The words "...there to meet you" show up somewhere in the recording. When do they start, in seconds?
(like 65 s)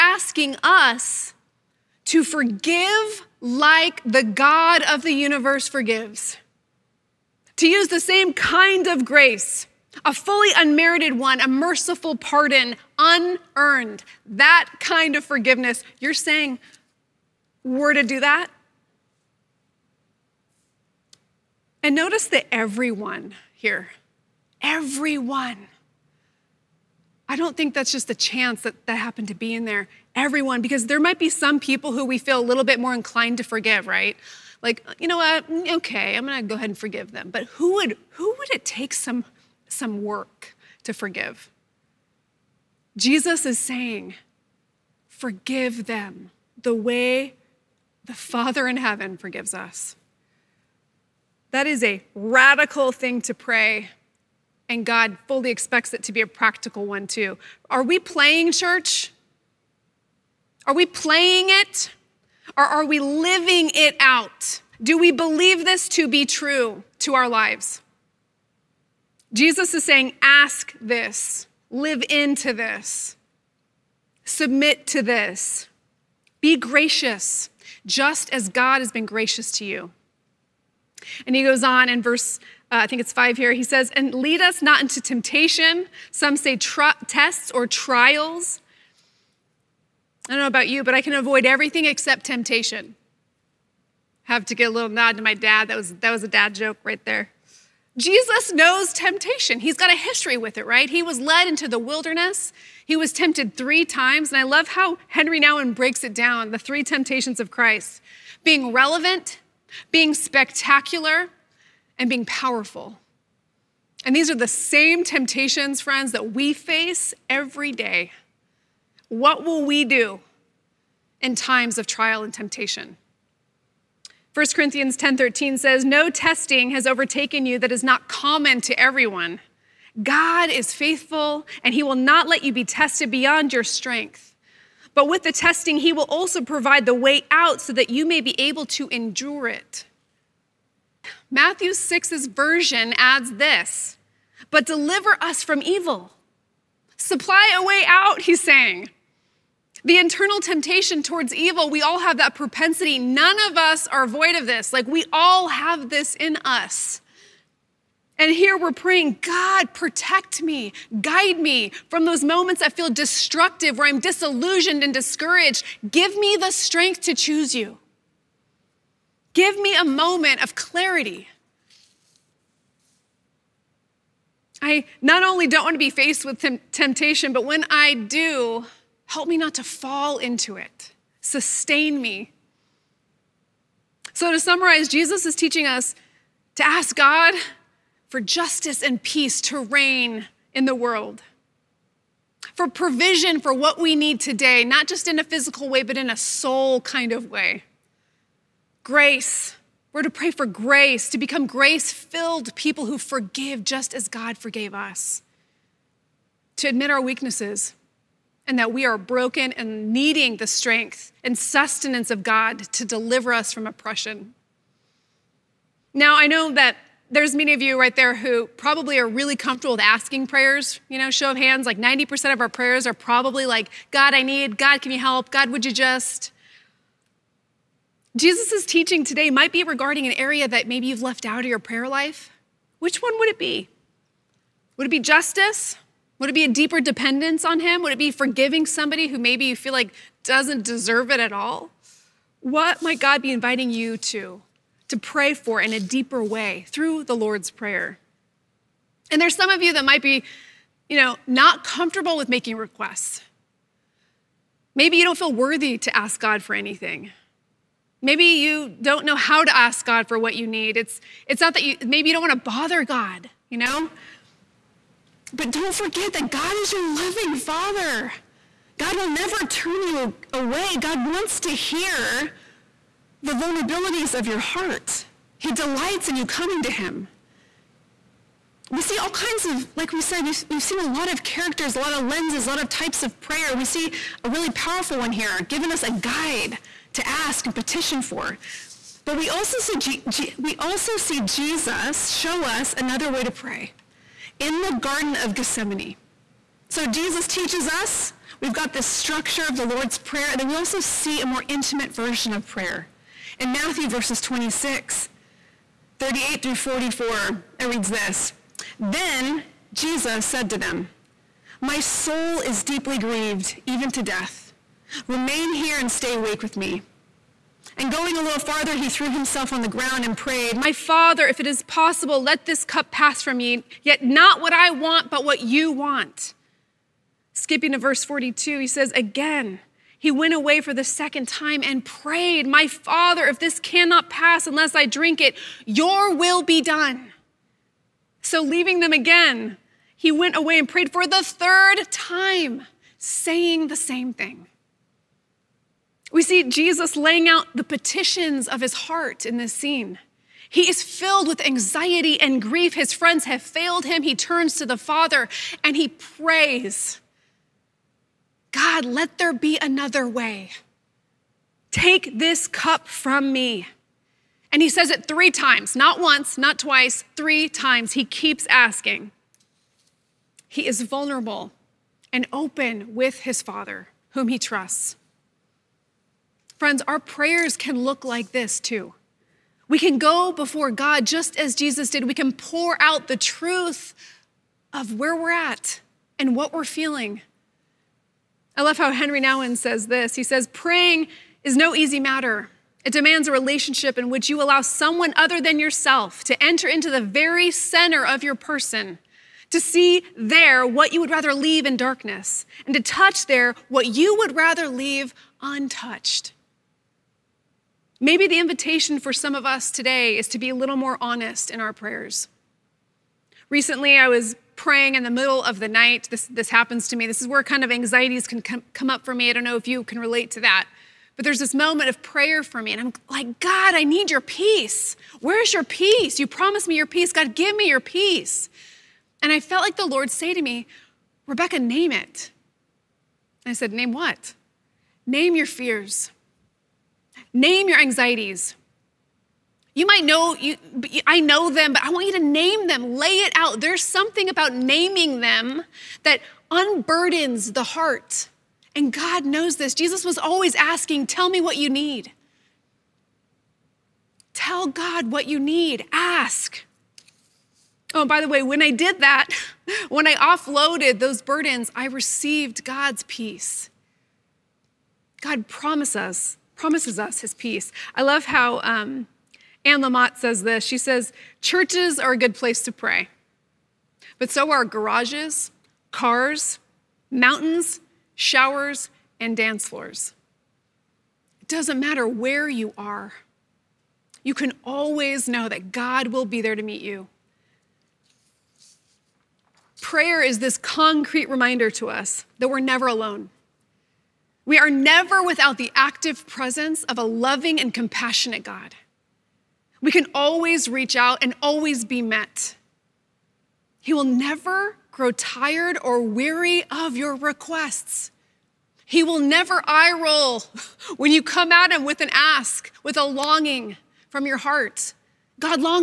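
486 s.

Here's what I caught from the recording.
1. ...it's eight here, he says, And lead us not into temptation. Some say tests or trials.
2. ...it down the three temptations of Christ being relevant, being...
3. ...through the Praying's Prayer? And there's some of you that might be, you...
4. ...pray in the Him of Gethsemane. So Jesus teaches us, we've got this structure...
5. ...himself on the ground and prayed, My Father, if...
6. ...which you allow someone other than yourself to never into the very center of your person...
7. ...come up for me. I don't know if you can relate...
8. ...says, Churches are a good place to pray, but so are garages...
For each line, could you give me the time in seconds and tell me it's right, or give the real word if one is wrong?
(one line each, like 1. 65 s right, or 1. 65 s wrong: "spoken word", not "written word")
1. 83 s wrong: "five", not "eight"
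2. 106 s right
3. 246 s wrong: "Lord", not "Praying"
4. 293 s wrong: "Garden", not "Him"
5. 319 s right
6. 394 s wrong: "enter", not "never"
7. 418 s right
8. 470 s right.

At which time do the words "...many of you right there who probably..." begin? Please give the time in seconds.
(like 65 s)
217 s.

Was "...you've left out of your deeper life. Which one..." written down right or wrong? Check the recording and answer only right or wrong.
wrong.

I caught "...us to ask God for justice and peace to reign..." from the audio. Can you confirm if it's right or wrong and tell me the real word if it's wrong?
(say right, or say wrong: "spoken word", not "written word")
right.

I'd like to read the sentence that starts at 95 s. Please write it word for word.
That was, that was a dad joke right there.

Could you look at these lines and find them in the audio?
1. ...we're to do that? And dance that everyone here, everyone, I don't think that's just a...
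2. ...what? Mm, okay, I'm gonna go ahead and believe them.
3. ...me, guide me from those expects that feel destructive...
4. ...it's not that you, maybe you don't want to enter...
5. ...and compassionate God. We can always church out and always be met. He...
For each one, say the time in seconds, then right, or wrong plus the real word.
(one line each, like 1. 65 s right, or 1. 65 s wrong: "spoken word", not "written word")
1. 17 s wrong: "notice", not "dance"
2. 35 s wrong: "forgive", not "believe"
3. 160 s wrong: "moments", not "expects"
4. 261 s wrong: "bother", not "enter"
5. 497 s wrong: "reach", not "church".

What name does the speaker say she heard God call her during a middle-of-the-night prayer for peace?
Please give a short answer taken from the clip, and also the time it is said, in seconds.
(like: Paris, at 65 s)
Rebecca, at 431 s.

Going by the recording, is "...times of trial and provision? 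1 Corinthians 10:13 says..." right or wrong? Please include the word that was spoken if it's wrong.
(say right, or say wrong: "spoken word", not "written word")
wrong: "temptation", not "provision".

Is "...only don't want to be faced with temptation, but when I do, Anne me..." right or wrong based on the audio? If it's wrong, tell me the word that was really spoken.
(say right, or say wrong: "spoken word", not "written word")
wrong: "Help", not "Anne".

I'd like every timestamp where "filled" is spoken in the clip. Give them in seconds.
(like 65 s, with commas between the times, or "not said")
201 s, 350 s.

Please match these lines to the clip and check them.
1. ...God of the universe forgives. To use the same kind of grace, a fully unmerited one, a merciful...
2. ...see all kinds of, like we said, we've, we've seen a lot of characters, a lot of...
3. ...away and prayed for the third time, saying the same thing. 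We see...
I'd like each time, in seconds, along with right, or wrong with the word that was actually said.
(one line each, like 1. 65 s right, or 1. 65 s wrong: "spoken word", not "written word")
1. 4 s right
2. 278 s right
3. 340 s right.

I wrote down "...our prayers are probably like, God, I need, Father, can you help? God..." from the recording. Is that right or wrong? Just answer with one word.
wrong.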